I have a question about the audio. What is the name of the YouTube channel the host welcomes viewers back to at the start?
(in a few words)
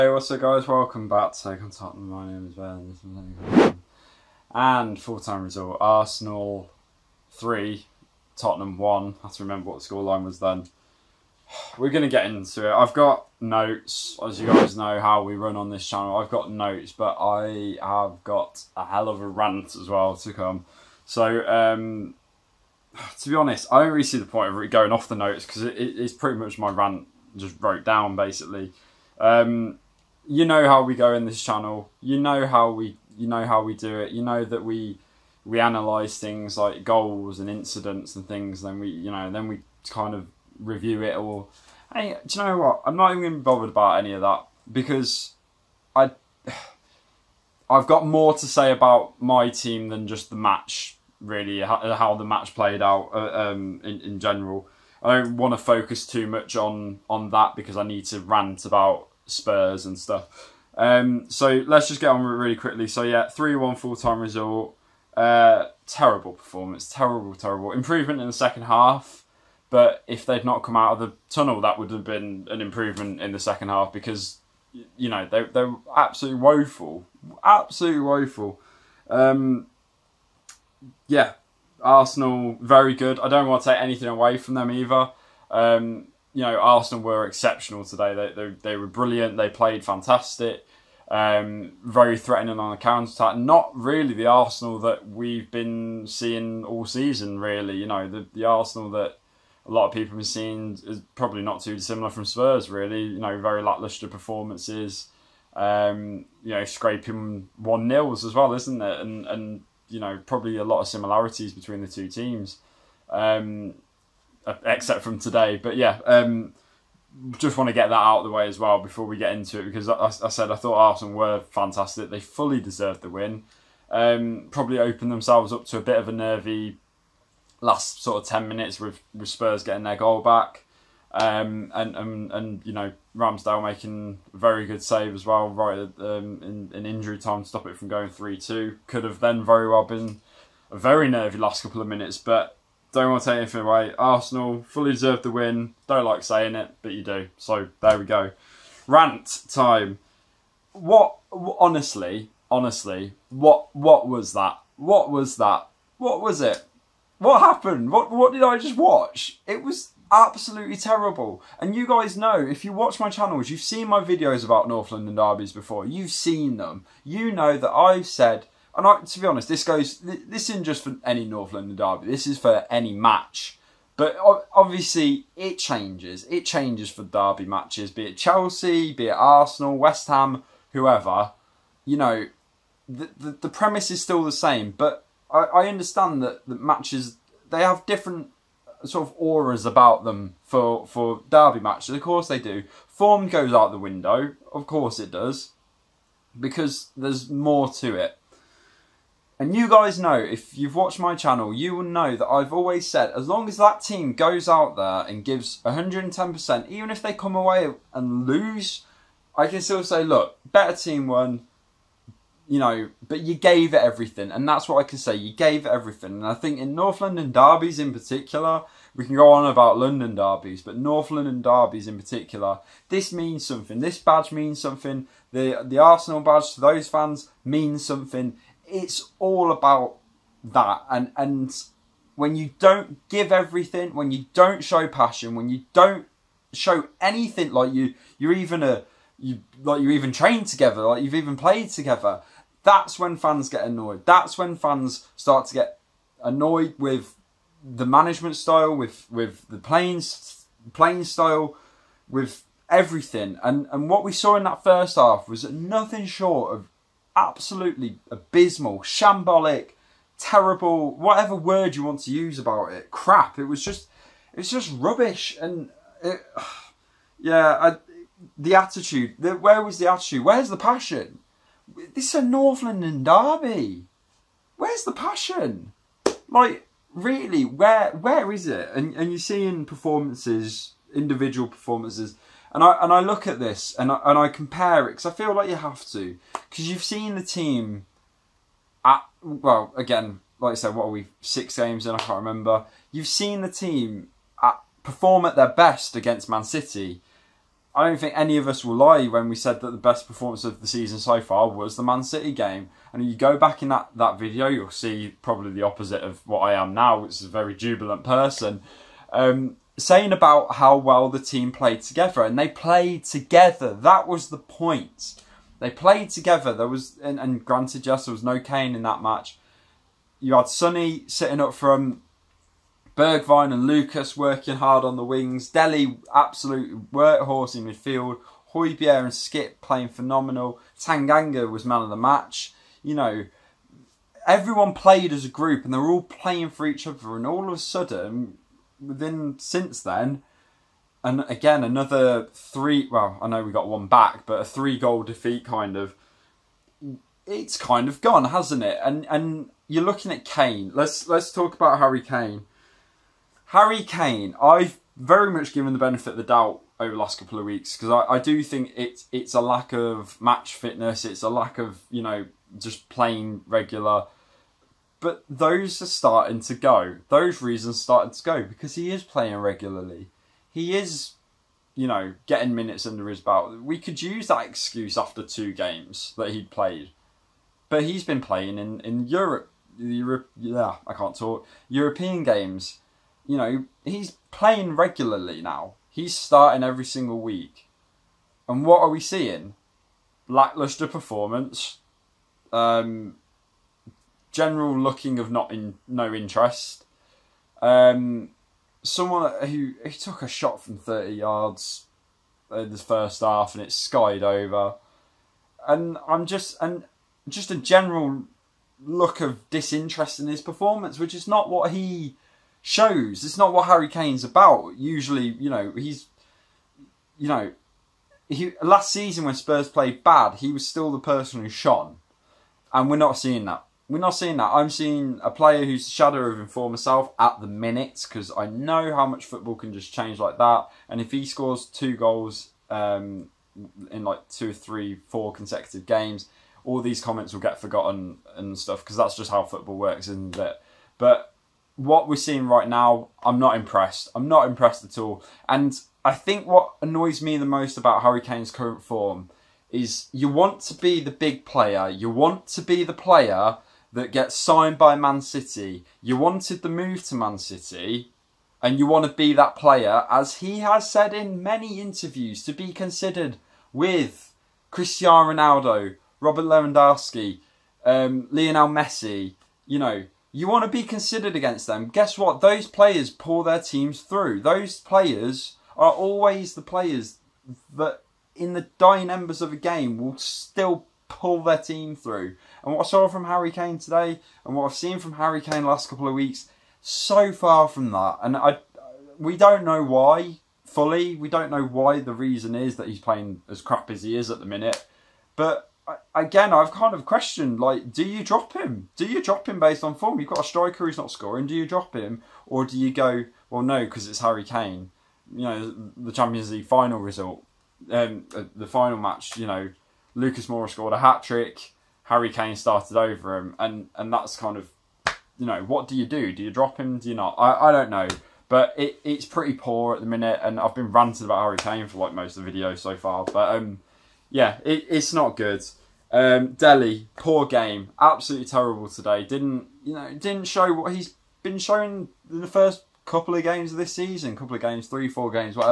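Take Tottenham.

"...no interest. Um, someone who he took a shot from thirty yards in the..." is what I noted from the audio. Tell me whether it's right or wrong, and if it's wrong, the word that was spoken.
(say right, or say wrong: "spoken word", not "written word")
right.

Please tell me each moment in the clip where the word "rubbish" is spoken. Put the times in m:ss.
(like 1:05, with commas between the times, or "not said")
4:24.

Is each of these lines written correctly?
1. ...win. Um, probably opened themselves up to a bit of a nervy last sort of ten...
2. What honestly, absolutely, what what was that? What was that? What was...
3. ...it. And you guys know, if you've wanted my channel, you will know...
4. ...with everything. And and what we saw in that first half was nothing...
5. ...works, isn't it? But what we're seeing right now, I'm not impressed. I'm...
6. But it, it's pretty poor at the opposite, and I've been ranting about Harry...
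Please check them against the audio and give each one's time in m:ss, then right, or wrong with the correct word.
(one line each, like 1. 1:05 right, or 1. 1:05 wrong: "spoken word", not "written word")
1. 2:03 right
2. 2:30 wrong: "honestly", not "absolutely"
3. 3:17 wrong: "watched", not "wanted"
4. 4:12 right
5. 7:19 right
6. 8:38 wrong: "minute", not "opposite".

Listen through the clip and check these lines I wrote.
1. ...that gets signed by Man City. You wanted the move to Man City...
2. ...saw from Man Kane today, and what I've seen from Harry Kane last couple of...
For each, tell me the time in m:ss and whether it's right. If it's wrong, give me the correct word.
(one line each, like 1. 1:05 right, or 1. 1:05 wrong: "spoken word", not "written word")
1. 7:33 right
2. 8:02 wrong: "Harry", not "Man".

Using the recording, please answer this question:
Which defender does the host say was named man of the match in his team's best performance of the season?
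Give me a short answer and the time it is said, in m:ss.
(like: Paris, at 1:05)
Tanganga, at 5:30.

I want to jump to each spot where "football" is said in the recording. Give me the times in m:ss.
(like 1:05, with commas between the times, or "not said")
7:09, 7:19.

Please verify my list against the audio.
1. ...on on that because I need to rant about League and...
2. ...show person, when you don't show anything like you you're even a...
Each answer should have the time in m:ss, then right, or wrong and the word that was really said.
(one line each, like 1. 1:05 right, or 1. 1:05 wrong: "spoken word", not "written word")
1. 0:56 wrong: "Spurs", not "League"
2. 3:54 wrong: "passion", not "person".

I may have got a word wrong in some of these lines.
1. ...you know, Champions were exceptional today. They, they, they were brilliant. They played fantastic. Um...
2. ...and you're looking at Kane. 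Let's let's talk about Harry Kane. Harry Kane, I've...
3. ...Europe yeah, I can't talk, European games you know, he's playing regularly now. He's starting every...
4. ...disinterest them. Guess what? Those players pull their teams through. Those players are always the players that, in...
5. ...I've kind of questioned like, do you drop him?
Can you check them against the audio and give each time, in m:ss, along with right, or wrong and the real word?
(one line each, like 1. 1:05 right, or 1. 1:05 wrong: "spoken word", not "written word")
1. 1:26 wrong: "Arsenal", not "Champions"
2. 5:49 right
3. 6:19 right
4. 7:51 wrong: "against", not "disinterest"
5. 8:16 right.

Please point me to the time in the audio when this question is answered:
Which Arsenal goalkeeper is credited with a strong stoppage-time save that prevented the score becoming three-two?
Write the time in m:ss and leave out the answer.
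2:13.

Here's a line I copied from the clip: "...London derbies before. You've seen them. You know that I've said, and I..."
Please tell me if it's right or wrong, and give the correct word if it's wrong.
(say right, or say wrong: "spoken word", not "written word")
right.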